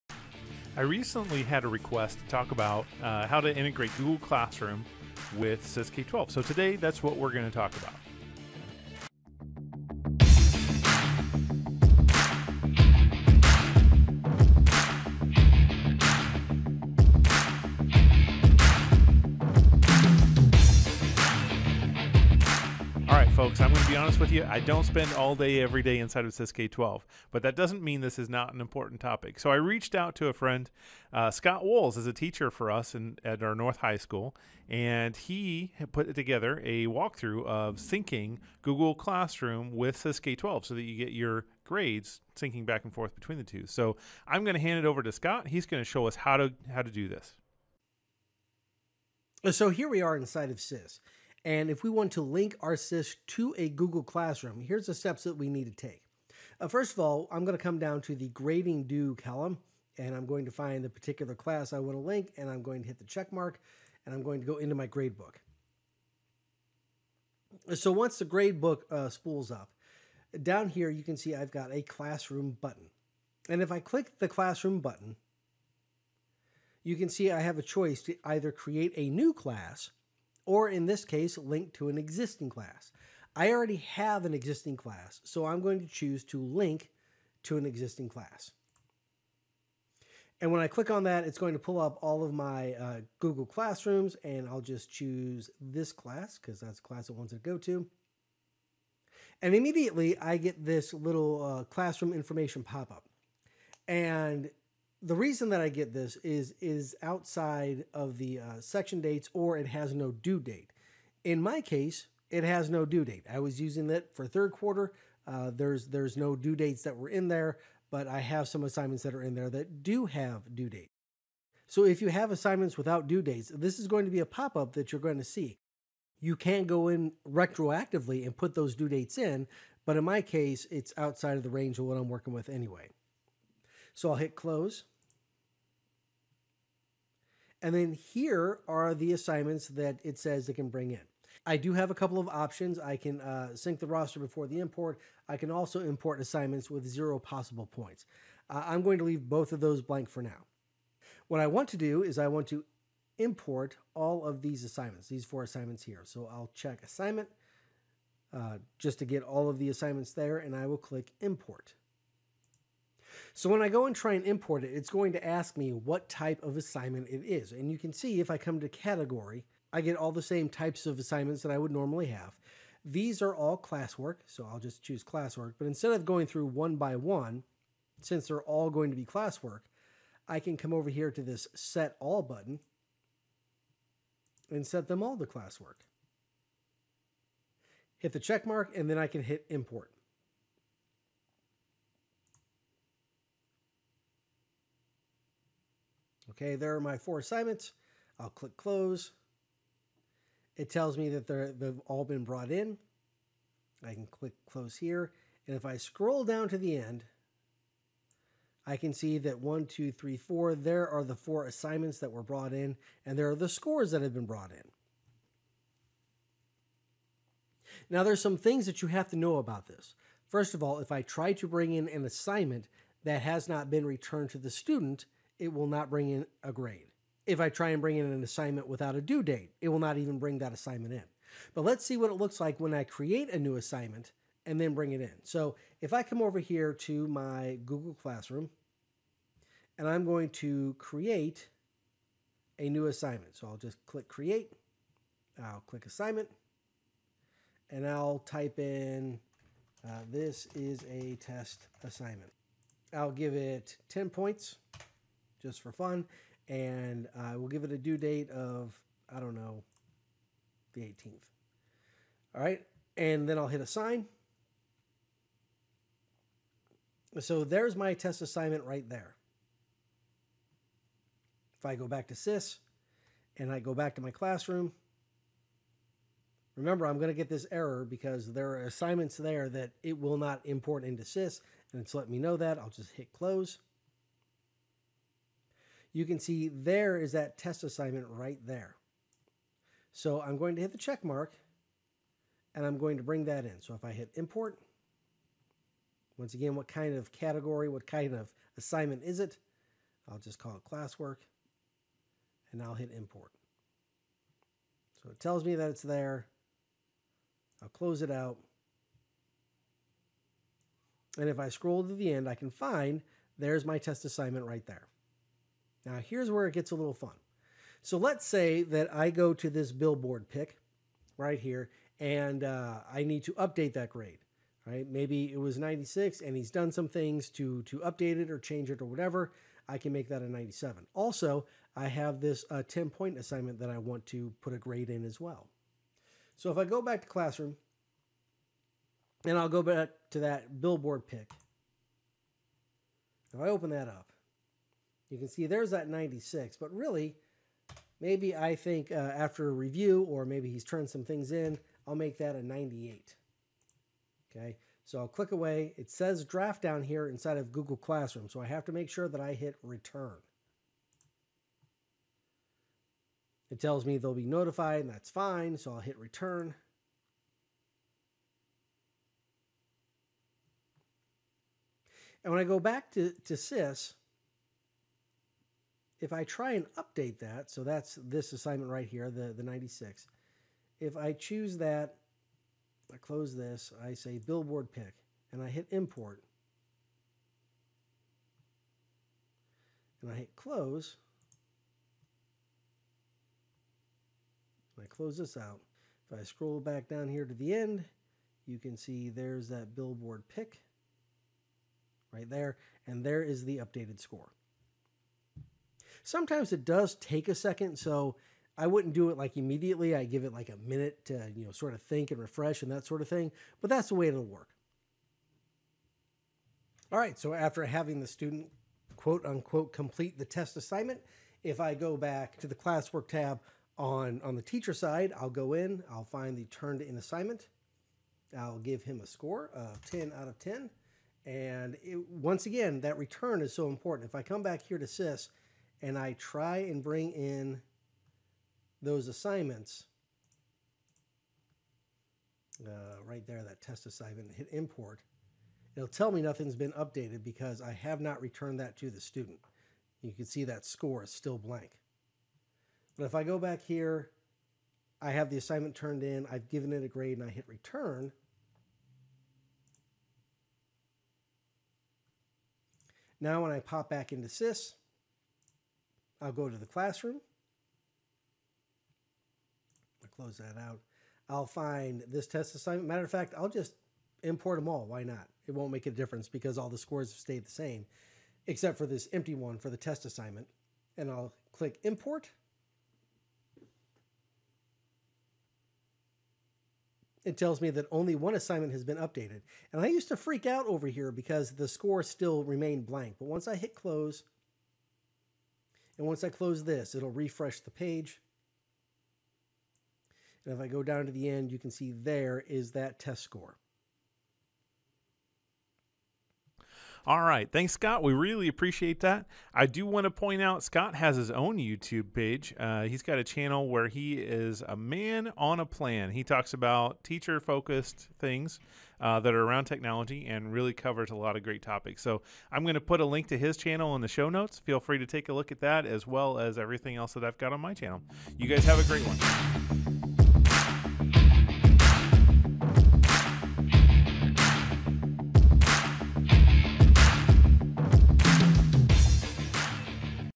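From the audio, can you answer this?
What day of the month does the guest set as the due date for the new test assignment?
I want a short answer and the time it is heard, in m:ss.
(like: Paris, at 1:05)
18th, at 4:20.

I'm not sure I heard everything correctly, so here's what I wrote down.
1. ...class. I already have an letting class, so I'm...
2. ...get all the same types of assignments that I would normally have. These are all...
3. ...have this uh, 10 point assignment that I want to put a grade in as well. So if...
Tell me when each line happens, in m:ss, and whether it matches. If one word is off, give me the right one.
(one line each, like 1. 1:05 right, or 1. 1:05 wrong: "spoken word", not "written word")
1. 1:22 wrong: "existing", not "letting"
2. 2:49 right
3. 5:31 right.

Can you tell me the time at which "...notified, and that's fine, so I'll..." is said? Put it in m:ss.
6:04.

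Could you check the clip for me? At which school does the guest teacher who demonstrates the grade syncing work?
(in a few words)
North High School.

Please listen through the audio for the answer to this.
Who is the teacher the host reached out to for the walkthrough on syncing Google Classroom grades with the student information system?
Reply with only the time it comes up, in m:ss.
0:31.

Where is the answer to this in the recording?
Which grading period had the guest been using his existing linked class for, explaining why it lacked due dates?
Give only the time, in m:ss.
1:54.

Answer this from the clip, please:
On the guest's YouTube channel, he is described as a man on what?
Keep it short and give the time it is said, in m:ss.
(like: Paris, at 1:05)
a plan, at 8:35.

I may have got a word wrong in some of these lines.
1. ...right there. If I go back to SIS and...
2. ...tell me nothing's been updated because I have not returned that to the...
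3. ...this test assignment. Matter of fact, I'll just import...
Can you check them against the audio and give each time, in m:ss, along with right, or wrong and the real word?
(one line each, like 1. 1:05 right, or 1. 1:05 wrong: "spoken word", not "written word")
1. 4:28 right
2. 7:25 right
3. 7:52 right.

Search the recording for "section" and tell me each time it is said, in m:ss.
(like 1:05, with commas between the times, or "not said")
1:48.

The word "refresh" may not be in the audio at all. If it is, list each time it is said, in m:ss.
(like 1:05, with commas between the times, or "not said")
6:52, 8:17.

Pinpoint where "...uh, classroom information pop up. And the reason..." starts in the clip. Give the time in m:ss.
1:41.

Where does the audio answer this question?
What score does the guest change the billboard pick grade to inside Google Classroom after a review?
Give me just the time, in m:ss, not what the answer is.
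5:52.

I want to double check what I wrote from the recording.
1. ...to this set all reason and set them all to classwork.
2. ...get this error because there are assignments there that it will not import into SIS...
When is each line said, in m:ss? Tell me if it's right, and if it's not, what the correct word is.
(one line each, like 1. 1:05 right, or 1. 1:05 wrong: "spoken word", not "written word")
1. 3:01 wrong: "button", not "reason"
2. 4:37 right.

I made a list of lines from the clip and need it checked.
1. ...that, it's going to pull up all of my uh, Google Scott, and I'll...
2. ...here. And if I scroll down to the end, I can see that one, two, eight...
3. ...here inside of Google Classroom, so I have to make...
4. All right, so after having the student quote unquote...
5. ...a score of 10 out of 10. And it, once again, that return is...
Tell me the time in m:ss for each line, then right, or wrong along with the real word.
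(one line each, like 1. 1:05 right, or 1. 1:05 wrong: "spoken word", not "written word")
1. 1:31 wrong: "Classrooms", not "Scott"
2. 3:24 wrong: "three", not "eight"
3. 5:56 right
4. 6:56 right
5. 7:09 right.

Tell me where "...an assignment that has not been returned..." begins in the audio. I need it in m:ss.
3:41.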